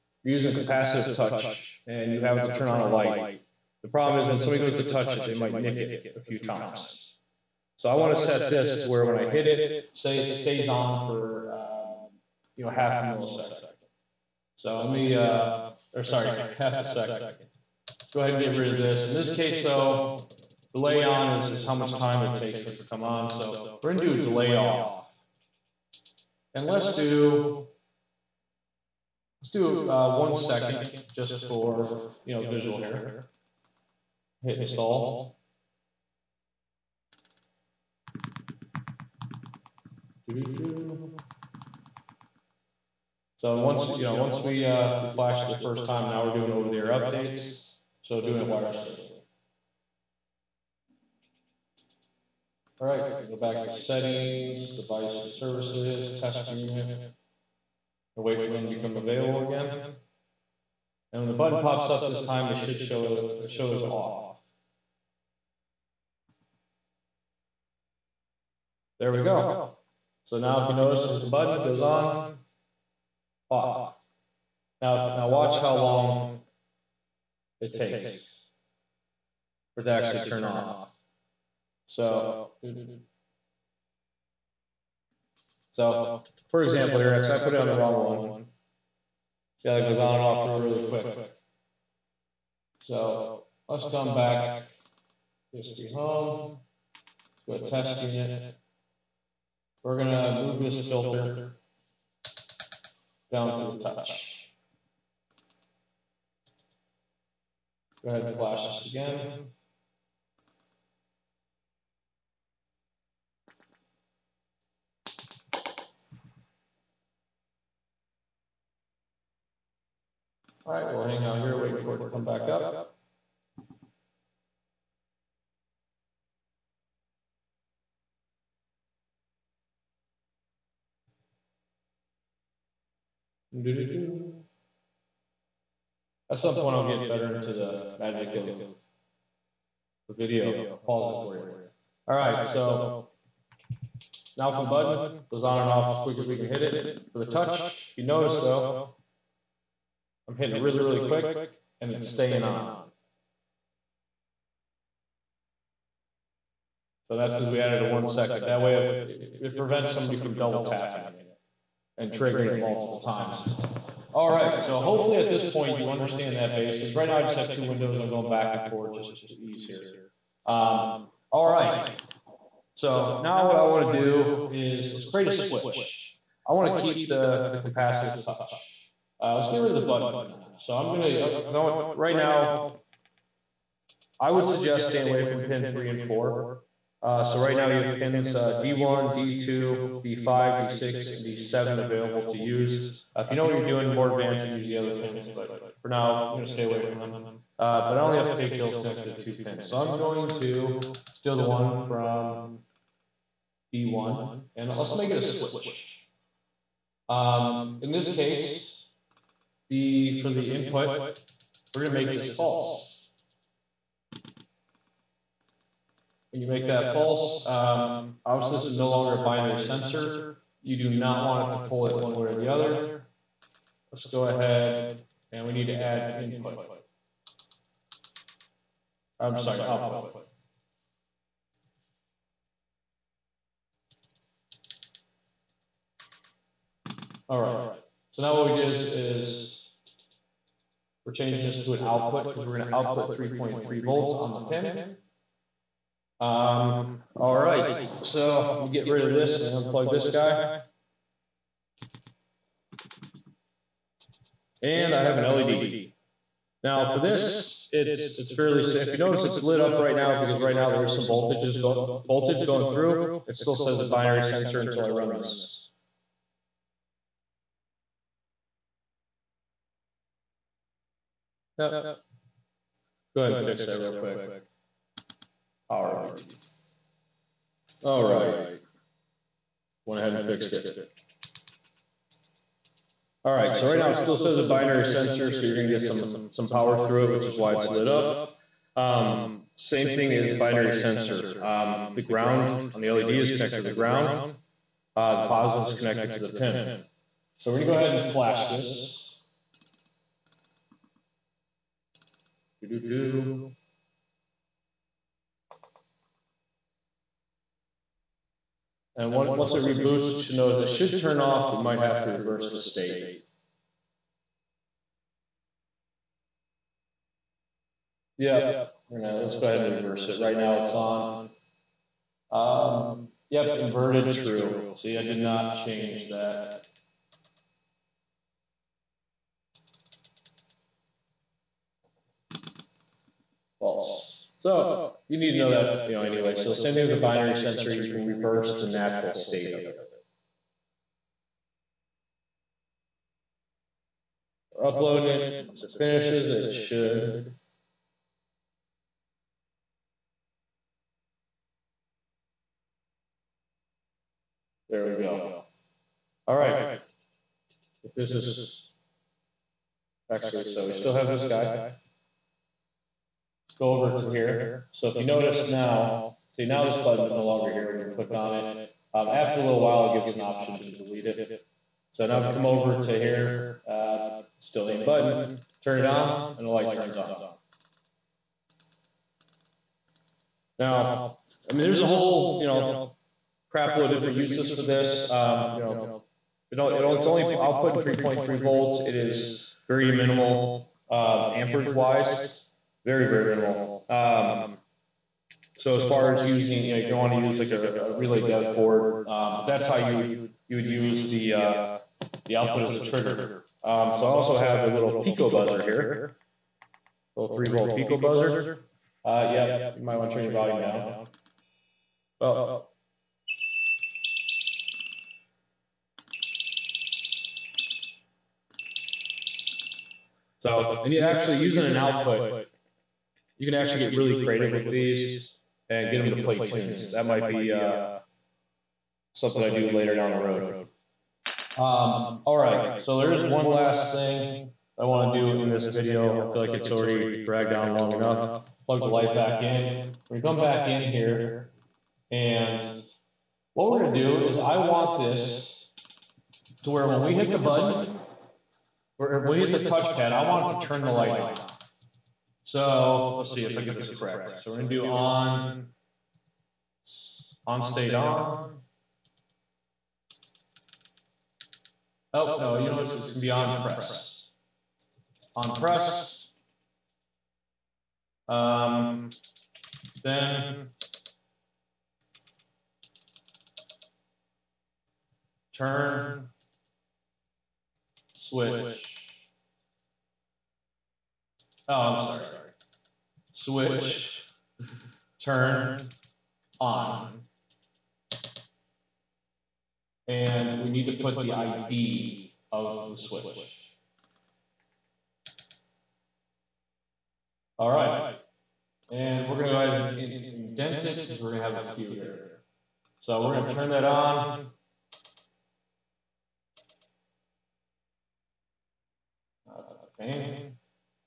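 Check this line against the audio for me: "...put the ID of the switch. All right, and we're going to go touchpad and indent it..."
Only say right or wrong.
wrong.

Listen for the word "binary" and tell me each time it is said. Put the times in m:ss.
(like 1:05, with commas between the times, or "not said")
3:39, 4:23, 4:44, 4:50, 5:36.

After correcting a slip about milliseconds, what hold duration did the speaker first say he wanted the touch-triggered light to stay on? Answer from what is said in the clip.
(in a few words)
half a second.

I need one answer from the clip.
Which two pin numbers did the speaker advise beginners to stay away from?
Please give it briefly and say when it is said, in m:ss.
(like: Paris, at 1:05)
3 and 4, at 3:05.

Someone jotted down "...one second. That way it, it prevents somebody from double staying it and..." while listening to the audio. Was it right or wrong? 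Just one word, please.
wrong.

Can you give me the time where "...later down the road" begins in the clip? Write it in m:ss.
7:09.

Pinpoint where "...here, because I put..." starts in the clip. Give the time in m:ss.
1:26.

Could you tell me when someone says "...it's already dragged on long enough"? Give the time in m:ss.
7:16.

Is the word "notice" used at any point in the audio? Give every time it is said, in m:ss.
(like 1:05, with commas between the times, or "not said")
1:10, 2:28, 4:18, 5:10, 6:05.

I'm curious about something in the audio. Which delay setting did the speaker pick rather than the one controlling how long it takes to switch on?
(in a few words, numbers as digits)
delay off.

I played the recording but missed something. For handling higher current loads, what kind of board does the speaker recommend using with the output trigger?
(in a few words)
relay dev board.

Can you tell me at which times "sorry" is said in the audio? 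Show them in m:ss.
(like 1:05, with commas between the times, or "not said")
0:16, 3:49, 8:01.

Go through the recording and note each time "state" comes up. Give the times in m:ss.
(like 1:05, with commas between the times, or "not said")
5:12, 5:39, 7:37.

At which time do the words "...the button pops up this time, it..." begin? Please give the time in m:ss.
1:01.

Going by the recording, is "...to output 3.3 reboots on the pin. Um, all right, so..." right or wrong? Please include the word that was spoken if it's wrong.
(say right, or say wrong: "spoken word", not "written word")
wrong: "volts", not "reboots".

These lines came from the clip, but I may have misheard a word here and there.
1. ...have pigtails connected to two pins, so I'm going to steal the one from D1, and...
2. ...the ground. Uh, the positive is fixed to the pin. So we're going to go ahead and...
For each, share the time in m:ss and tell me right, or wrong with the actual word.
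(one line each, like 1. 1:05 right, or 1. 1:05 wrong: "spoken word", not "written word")
1. 3:18 right
2. 4:53 wrong: "connected", not "fixed".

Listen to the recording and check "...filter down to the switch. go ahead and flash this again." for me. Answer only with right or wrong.
wrong.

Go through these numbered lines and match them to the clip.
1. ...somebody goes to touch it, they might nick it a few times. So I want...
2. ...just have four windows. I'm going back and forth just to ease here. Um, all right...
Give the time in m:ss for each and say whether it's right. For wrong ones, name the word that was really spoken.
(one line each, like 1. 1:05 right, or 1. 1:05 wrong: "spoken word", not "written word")
1. 0:04 right
2. 2:47 wrong: "two", not "four".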